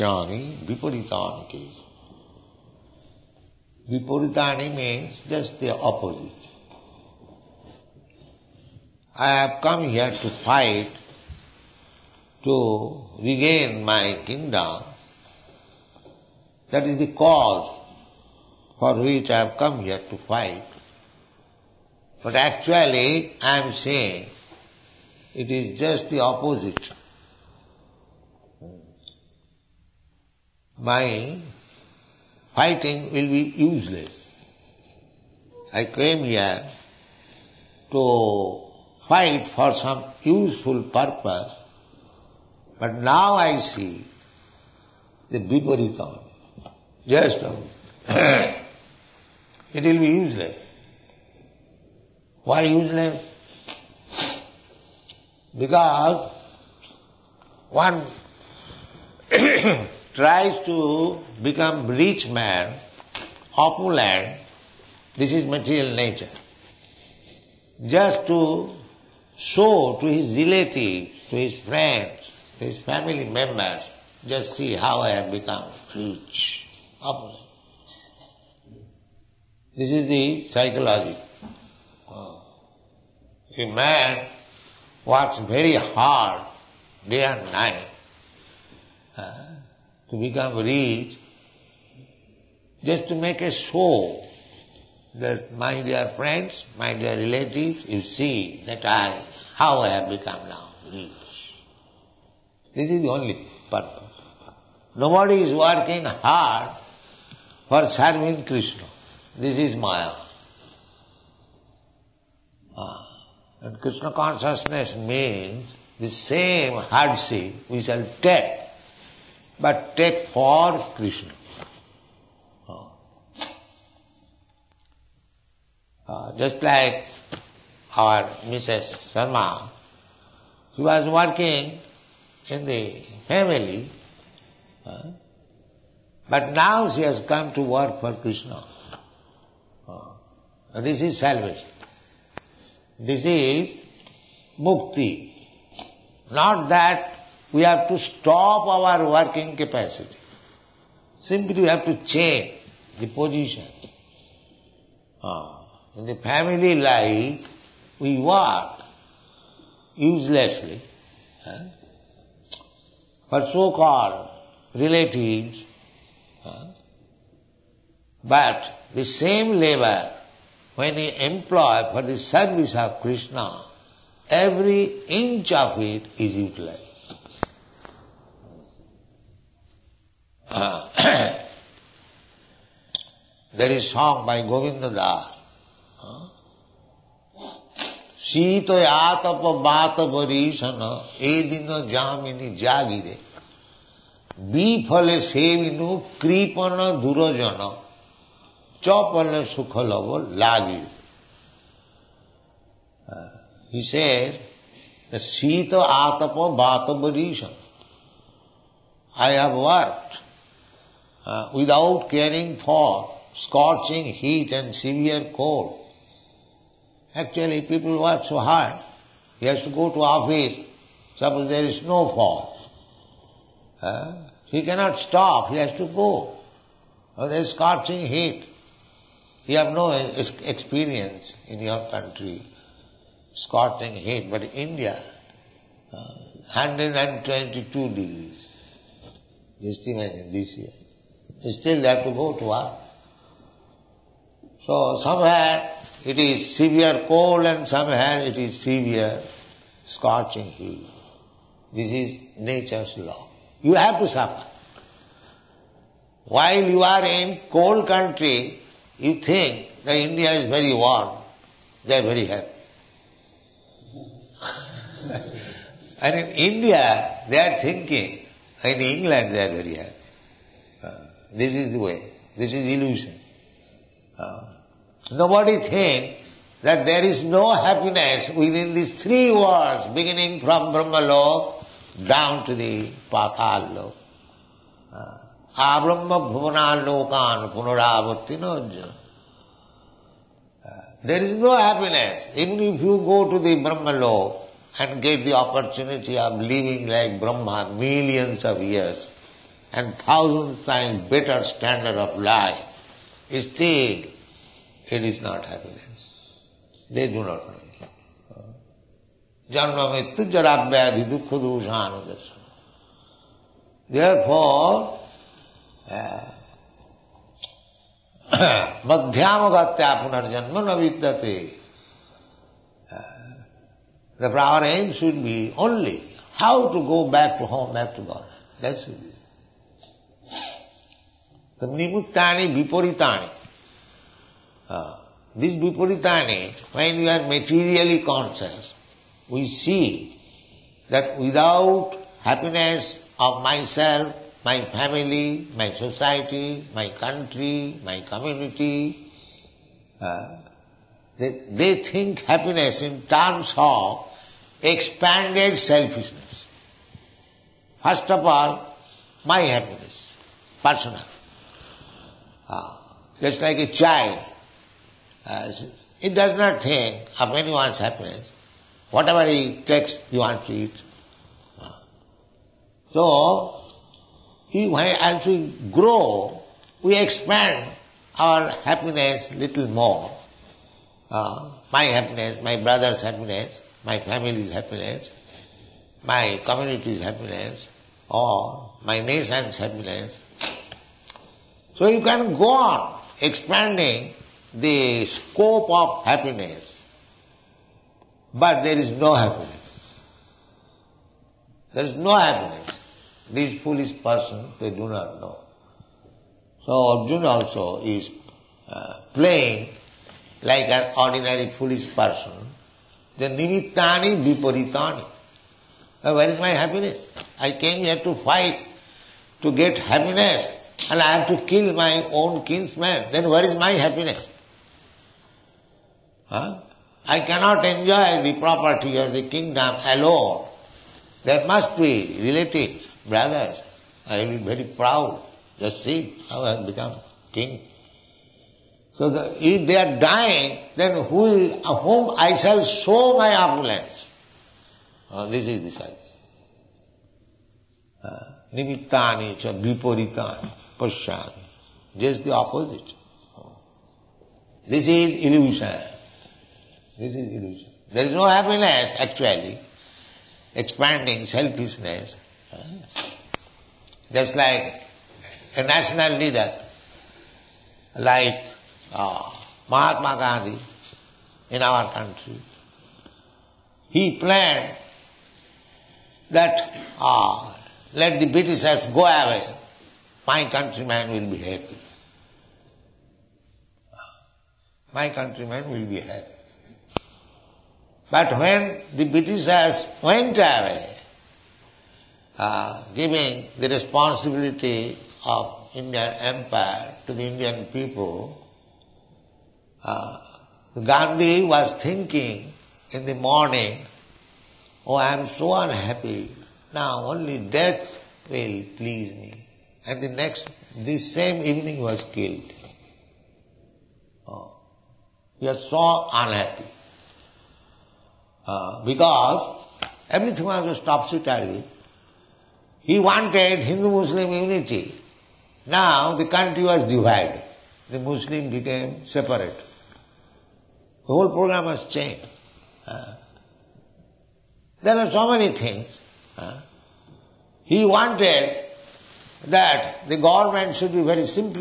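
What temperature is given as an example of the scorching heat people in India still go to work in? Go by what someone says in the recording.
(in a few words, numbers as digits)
122 degrees.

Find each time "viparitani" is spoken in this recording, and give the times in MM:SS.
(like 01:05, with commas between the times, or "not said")
06:54, 07:29.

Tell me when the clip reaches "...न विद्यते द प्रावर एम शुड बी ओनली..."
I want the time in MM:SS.
05:20.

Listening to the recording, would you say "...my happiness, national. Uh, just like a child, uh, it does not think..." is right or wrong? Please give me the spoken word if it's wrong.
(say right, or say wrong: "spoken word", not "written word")
wrong: "personal", not "national".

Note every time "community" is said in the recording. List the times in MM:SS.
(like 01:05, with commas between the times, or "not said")
05:48, 06:26.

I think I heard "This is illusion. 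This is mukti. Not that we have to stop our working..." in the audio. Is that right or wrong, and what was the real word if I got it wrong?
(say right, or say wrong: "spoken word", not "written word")
wrong: "salvation", not "illusion".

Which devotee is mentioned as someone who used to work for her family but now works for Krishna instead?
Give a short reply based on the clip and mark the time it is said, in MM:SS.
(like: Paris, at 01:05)
Mrs. Sharma, at 02:08.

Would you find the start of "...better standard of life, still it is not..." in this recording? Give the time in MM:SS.
05:01.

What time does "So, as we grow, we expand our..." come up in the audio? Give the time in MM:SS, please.
06:12.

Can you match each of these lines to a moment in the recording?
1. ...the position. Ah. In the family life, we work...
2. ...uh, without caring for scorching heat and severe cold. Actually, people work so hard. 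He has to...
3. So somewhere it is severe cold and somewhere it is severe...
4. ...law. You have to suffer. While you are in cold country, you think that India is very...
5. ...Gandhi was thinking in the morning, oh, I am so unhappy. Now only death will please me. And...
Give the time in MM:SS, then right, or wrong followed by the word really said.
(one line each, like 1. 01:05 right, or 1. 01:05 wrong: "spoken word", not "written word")
1. 02:32 right
2. 03:31 right
3. 04:04 right
4. 04:12 right
5. 08:20 right.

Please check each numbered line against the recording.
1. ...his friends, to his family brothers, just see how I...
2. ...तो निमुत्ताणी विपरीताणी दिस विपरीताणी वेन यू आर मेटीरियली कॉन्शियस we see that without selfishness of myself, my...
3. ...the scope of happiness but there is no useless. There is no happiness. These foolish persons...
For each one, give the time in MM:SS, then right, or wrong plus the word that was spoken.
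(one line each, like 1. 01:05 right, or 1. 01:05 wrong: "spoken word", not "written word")
1. 01:11 wrong: "members", not "brothers"
2. 05:31 wrong: "happiness", not "selfishness"
3. 06:34 wrong: "happiness", not "useless".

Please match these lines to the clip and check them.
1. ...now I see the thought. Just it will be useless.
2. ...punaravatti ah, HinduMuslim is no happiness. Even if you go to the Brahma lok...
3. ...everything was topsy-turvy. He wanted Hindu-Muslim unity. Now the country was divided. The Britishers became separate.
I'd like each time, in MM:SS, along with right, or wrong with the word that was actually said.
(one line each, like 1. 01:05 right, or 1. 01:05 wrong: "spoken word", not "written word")
1. 00:42 right
2. 04:47 wrong: "There", not "HinduMuslim"
3. 08:40 wrong: "Muslim", not "Britishers".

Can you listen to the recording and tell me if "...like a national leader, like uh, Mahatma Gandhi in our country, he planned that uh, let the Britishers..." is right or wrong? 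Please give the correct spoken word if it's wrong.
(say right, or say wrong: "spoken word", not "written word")
right.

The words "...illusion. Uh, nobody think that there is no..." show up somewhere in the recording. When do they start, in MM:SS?
04:32.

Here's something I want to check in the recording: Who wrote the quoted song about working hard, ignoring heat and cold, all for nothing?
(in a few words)
Govinda Das.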